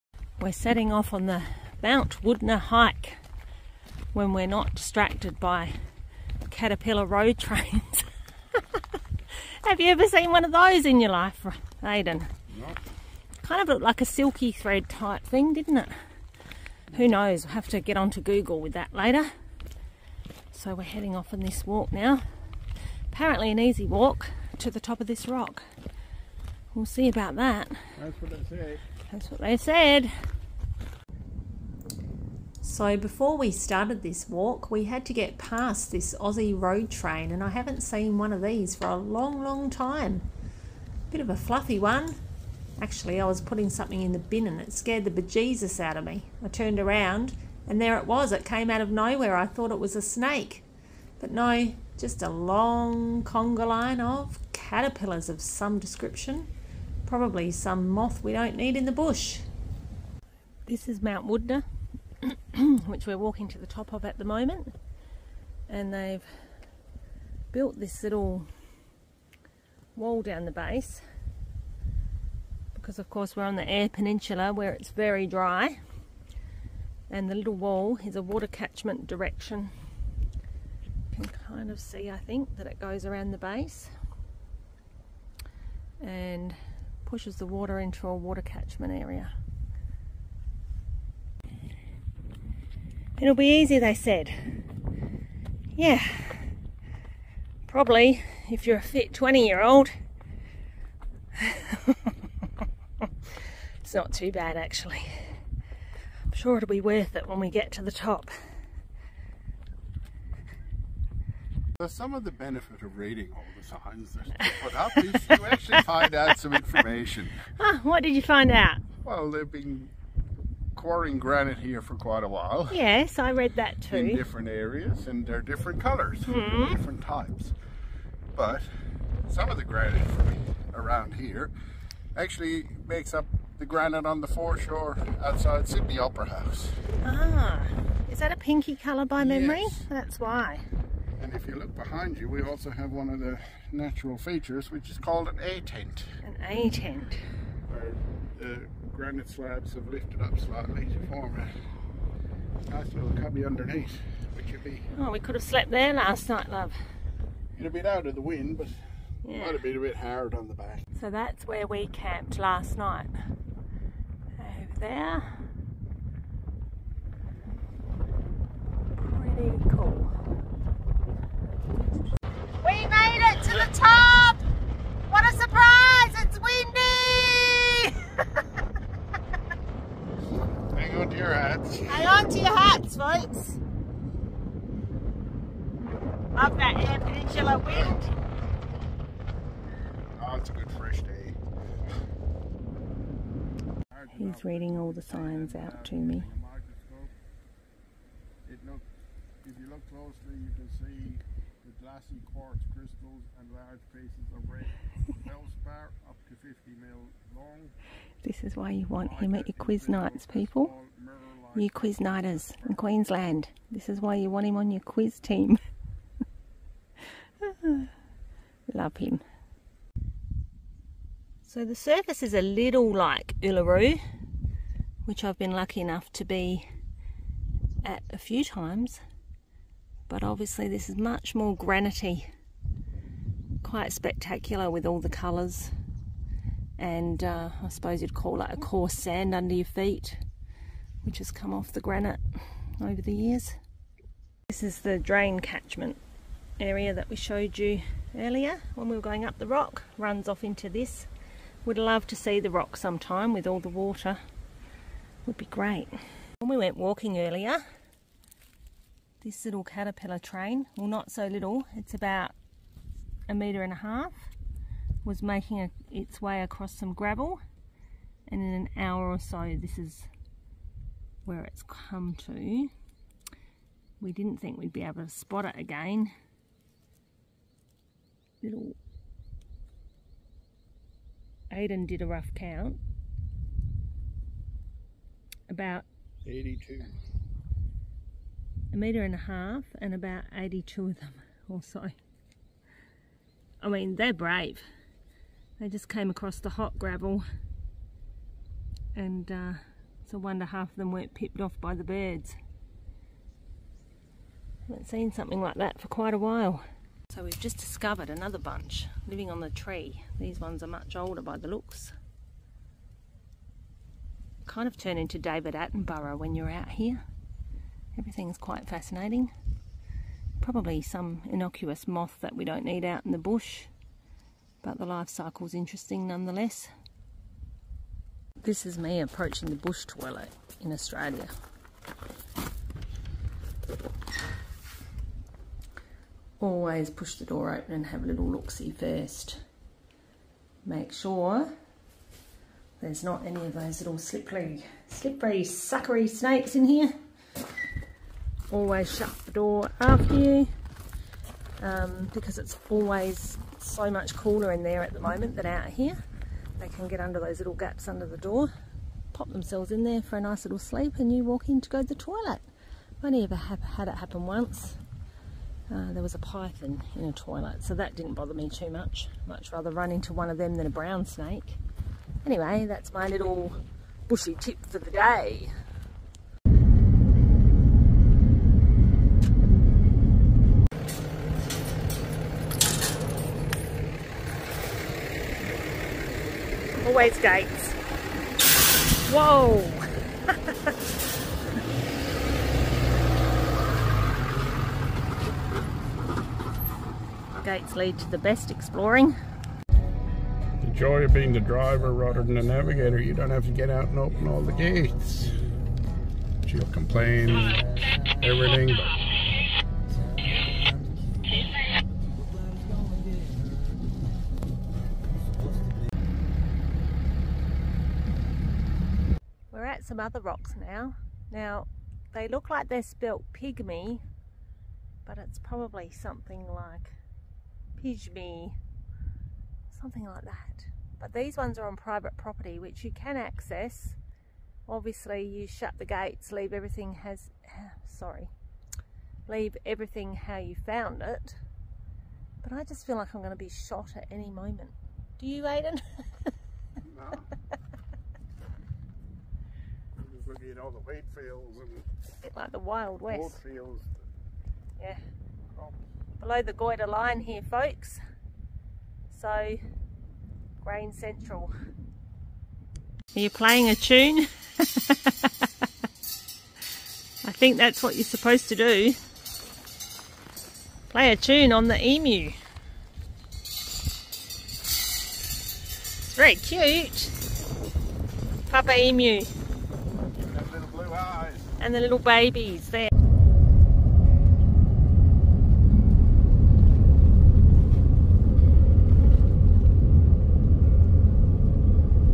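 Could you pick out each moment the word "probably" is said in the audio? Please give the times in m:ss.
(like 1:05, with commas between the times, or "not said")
0:57, 1:37, 5:20, 7:05.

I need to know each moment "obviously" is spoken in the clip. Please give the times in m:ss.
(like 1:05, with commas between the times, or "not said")
3:50, 7:14.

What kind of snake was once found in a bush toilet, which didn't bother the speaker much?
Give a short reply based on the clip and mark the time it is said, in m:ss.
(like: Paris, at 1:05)
python, at 6:06.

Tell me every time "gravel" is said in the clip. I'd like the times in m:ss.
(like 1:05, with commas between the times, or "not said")
4:26, 4:56.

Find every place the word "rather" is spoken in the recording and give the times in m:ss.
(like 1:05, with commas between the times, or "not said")
6:09, 6:41.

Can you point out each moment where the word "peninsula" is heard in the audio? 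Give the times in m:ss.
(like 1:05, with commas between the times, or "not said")
1:13, 3:06.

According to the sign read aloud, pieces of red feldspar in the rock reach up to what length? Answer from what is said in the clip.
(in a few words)
50 mm.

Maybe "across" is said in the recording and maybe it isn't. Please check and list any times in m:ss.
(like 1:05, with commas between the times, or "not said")
4:26, 4:56.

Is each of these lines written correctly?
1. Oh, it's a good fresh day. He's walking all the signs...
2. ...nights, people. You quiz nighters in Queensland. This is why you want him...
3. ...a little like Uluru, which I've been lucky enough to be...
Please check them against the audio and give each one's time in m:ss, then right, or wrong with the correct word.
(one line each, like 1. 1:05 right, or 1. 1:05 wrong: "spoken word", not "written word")
1. 3:10 wrong: "reading", not "walking"
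2. 3:29 right
3. 3:42 right.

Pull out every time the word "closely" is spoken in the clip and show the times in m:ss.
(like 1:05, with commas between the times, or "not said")
3:19.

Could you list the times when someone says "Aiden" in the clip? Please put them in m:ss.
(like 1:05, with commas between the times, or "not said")
0:11, 4:41, 7:25.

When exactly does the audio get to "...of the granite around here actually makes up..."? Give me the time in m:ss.
2:09.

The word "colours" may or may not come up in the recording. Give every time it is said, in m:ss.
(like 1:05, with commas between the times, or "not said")
2:05, 2:18, 3:55.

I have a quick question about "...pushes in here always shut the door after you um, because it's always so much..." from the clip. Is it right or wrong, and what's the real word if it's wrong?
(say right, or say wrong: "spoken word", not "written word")
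wrong: "snakes", not "pushes".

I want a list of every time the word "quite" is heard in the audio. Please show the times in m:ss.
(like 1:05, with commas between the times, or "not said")
2:01, 3:53, 5:05, 5:18.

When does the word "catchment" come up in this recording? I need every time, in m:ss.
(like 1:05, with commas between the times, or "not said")
1:18, 1:28, 4:05.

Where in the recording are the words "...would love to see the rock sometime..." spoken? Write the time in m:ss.
4:11.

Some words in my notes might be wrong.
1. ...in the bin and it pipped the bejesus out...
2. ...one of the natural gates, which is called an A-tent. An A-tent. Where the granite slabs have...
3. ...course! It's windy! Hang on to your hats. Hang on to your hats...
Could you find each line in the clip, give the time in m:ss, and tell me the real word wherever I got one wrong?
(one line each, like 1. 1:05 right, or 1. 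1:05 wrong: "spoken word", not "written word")
1. 0:44 wrong: "scared", not "pipped"
2. 2:22 wrong: "features", not "gates"
3. 2:55 wrong: "surprise", not "course".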